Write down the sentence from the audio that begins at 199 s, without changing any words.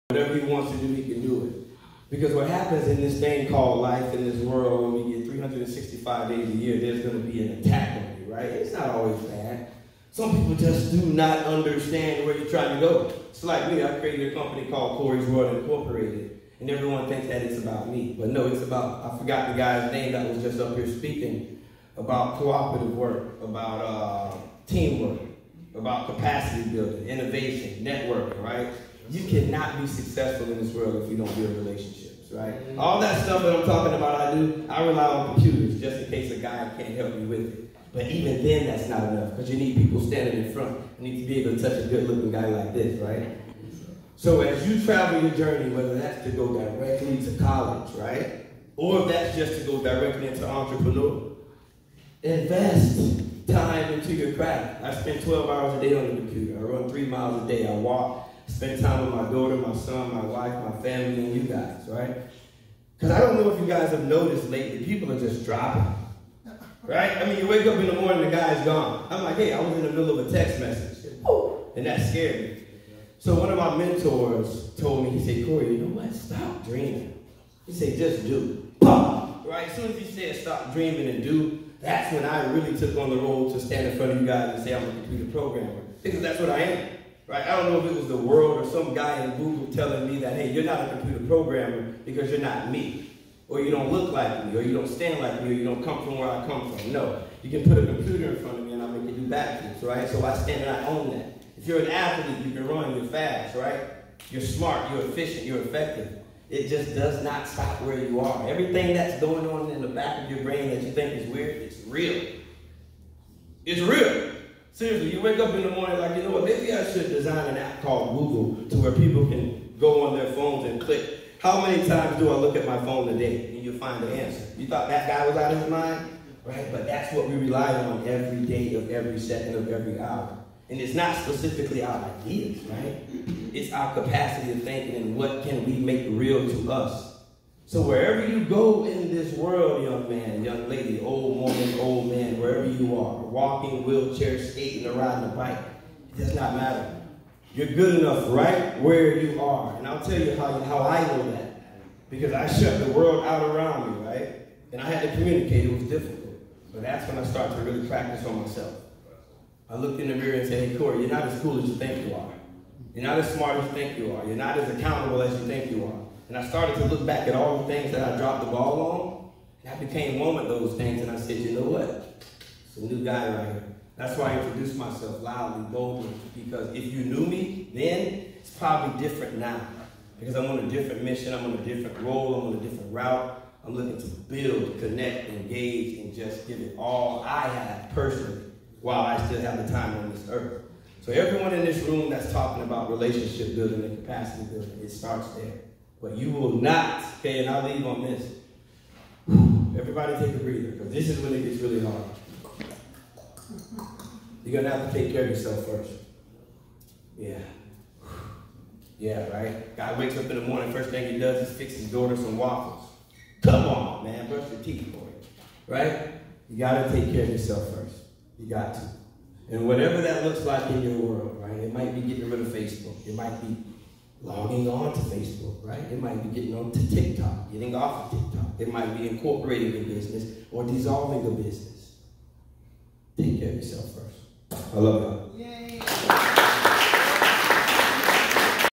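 Everybody take a breather, because this is when it gets really hard.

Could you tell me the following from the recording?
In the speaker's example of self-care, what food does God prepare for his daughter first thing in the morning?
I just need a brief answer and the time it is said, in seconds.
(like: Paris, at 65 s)
Waffles, at 212 s.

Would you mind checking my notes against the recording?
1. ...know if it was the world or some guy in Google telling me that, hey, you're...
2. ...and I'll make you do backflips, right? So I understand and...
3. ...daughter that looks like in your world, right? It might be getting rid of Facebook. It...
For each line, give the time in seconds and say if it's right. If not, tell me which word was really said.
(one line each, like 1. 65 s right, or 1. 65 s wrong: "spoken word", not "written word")
1. 87 s right
2. 98 s wrong: "stand", not "understand"
3. 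219 s wrong: "whatever", not "daughter".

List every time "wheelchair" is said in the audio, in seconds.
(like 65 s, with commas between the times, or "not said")
143 s.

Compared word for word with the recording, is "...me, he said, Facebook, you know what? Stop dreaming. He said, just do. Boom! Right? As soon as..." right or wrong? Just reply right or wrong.
wrong.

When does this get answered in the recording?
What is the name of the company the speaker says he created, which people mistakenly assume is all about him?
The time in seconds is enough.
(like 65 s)
14 s.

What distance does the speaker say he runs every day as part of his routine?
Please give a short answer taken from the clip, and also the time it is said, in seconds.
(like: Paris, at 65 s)
3 miles, at 56 s.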